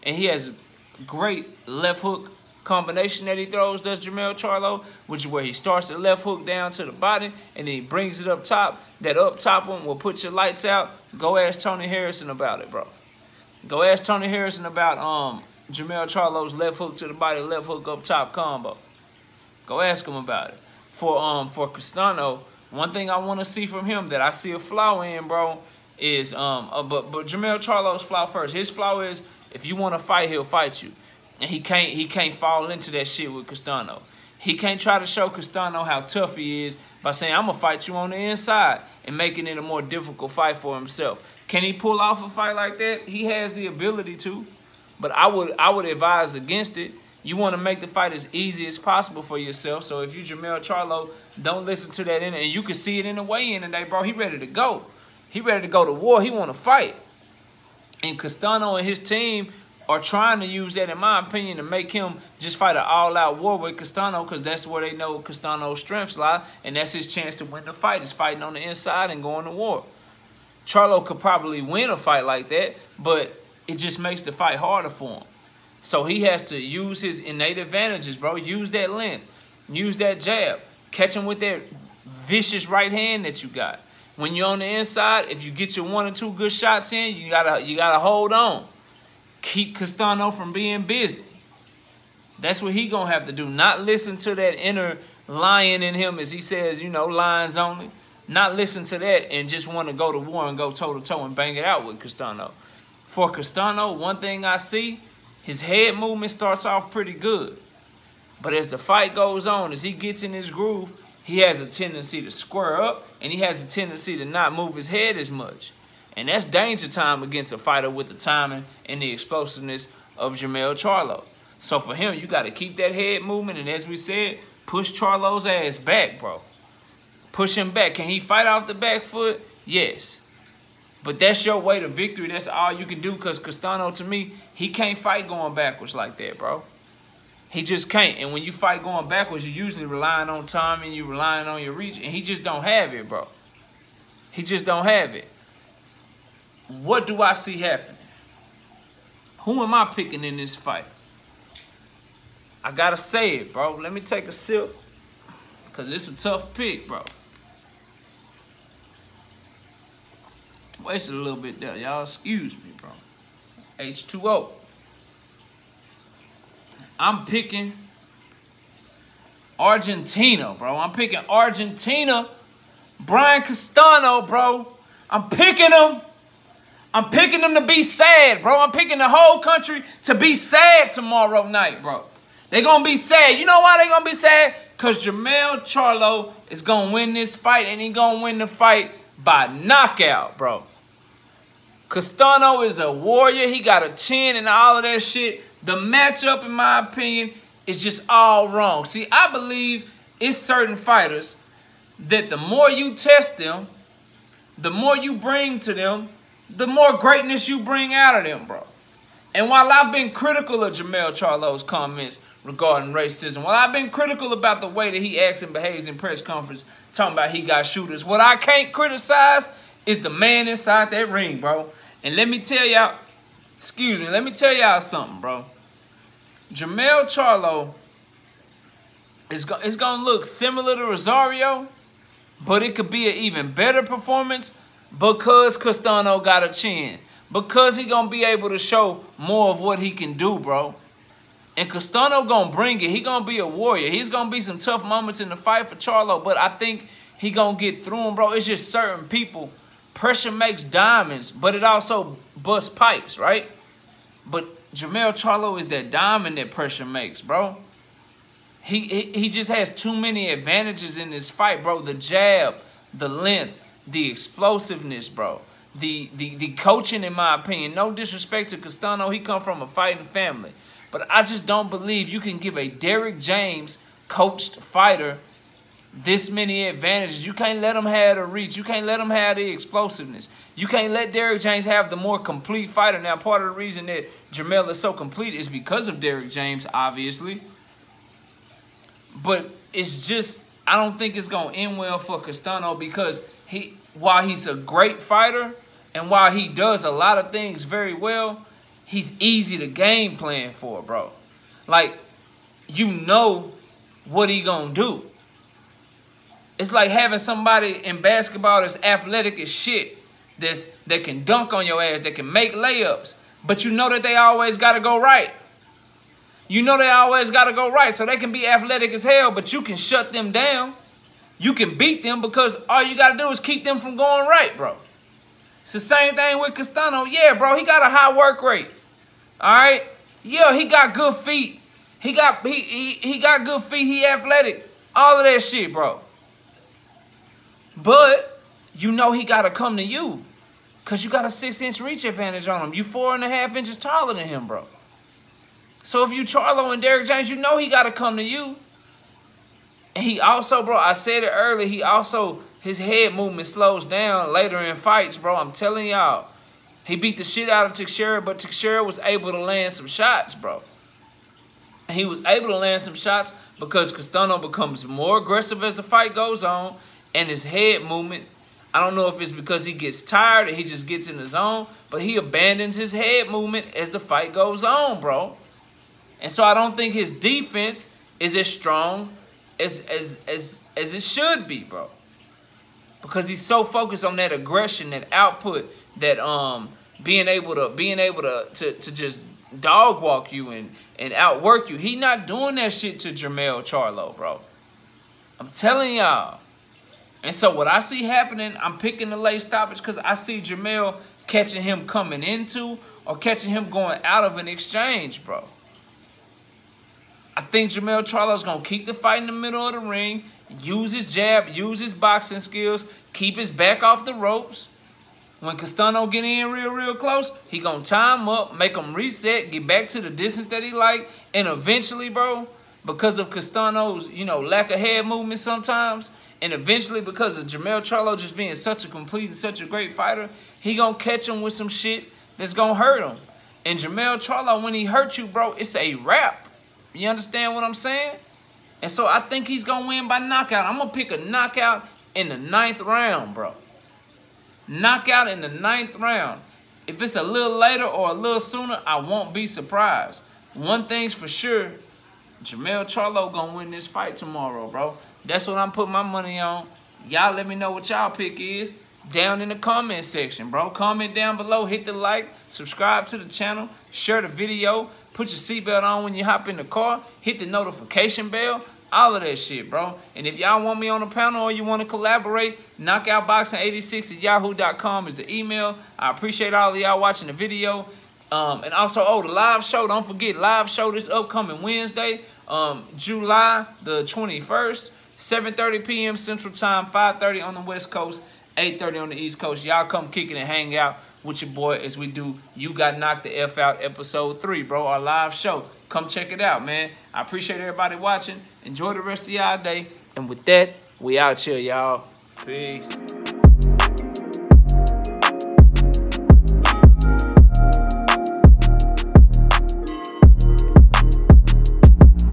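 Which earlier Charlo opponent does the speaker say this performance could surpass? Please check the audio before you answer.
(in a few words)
Rosario.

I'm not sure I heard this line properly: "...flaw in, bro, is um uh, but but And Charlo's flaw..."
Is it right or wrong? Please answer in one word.
wrong.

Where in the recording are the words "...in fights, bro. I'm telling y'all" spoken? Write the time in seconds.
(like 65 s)
354 s.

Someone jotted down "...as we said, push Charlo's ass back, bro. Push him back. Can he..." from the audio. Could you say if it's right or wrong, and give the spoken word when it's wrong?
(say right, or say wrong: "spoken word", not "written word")
right.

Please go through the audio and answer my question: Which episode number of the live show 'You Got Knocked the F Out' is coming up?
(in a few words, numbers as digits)
3.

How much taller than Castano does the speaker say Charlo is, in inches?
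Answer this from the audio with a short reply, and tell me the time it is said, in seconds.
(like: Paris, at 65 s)
4.5, at 342 s.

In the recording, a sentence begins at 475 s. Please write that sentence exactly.
I appreciate all of y'all watching the video.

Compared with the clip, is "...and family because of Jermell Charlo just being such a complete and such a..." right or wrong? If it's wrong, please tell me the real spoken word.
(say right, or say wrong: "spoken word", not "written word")
wrong: "eventually", not "family".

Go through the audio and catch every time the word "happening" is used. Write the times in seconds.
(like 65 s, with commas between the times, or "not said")
147 s, 398 s.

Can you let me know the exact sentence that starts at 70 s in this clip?
Charlo could probably win a fight like that, but it just makes the fight harder for him.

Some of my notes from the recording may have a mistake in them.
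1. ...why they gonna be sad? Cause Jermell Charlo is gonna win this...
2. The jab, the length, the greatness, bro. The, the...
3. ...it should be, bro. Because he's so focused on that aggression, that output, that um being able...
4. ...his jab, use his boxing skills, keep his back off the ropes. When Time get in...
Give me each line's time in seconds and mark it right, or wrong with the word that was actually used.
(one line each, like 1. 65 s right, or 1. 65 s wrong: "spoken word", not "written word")
1. 183 s right
2. 261 s wrong: "explosiveness", not "greatness"
3. 380 s right
4. 410 s wrong: "Castano", not "Time".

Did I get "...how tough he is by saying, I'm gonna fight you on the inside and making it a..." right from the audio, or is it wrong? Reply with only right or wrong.
right.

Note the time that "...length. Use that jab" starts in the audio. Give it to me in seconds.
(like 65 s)
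78 s.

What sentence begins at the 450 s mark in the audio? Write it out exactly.
One thing's for sure, Jermell Charlo going to win this fight tomorrow, bro.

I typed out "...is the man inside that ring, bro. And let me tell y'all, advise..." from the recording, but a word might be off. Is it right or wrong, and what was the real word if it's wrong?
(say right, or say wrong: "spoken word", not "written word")
wrong: "excuse", not "advise".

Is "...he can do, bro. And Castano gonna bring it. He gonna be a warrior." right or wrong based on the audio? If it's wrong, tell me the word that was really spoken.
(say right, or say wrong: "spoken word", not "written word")
right.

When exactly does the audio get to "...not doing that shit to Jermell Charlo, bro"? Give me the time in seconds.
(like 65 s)
391 s.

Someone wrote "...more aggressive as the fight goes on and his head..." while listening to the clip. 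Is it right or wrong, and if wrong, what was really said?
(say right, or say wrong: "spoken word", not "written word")
right.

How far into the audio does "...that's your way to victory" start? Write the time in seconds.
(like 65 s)
131 s.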